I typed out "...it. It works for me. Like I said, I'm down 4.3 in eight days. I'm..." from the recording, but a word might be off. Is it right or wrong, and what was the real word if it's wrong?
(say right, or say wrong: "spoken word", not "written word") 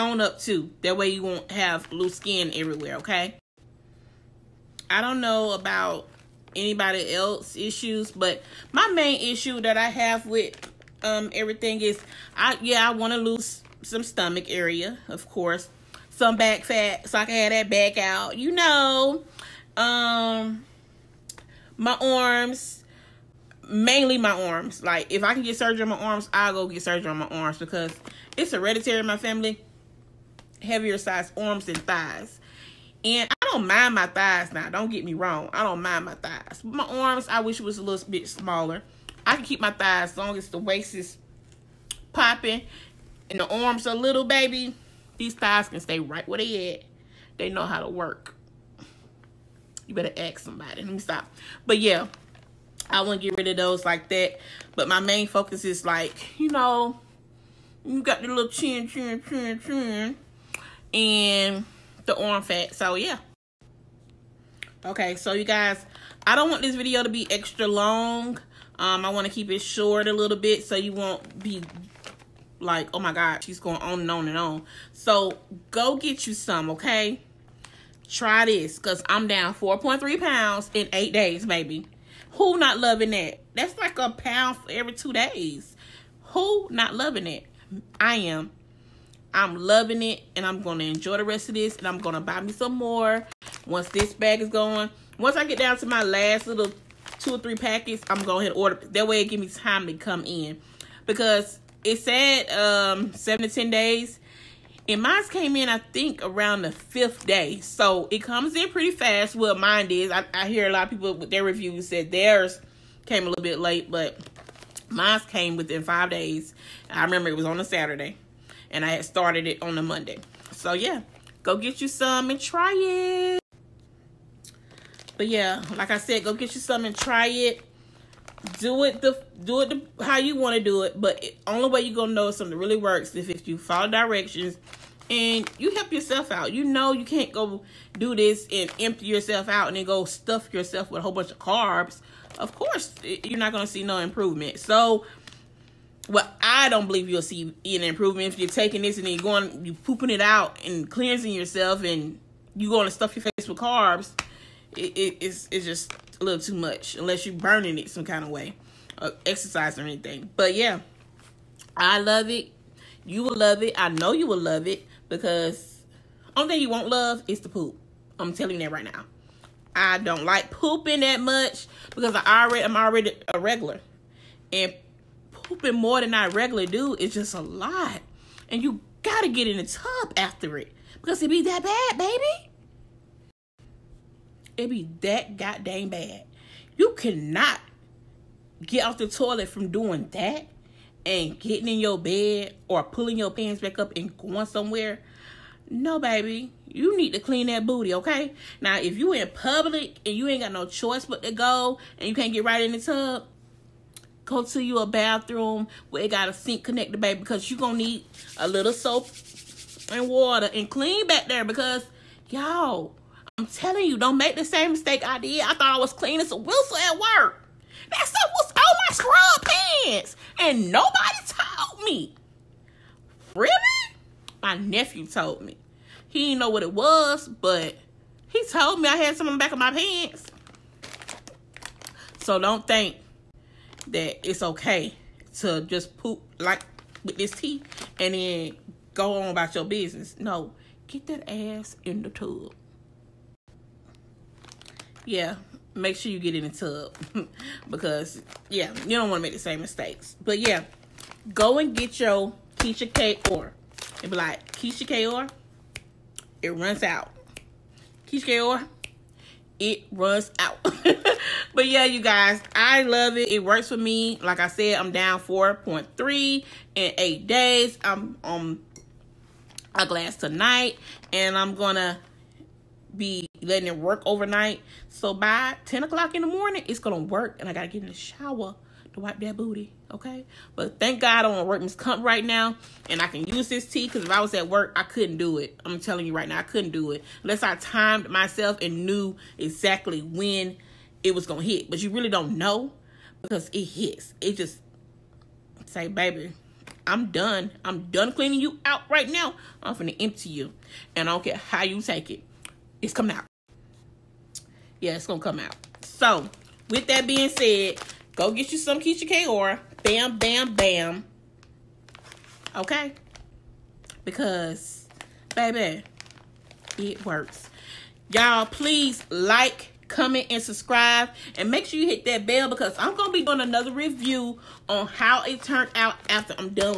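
right.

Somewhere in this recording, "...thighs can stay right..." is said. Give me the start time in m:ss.
0:45.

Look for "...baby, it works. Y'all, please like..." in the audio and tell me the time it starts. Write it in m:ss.
5:15.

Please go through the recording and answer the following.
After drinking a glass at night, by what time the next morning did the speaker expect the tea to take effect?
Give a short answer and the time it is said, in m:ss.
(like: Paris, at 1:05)
10 o'clock, at 4:35.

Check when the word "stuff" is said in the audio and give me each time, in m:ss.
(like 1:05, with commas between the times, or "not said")
2:20, 2:32, 3:38.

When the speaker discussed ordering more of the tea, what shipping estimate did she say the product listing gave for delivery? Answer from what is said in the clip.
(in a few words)
7 to 10 days.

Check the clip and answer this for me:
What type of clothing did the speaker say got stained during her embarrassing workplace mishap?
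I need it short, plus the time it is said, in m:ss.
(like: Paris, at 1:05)
Scrub pants, at 3:38.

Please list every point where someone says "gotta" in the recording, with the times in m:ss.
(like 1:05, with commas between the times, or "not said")
2:59, 4:37.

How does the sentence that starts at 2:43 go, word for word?
I know you will love it because only thing you won't love is the poop.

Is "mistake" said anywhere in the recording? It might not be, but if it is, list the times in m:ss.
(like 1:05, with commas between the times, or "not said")
3:34, 4:09.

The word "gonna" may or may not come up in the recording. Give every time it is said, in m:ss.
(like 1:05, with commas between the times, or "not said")
2:11, 3:27, 4:31, 4:36, 4:51, 5:05.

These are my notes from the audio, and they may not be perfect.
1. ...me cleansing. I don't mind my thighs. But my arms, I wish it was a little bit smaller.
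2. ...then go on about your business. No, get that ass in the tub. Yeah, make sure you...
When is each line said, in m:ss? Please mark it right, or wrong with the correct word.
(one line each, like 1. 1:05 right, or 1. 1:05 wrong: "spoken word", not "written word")
1. 0:35 wrong: "wrong", not "cleansing"
2. 3:58 right.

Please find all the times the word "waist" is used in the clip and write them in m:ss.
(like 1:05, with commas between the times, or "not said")
0:40.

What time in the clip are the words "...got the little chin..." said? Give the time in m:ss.
0:58.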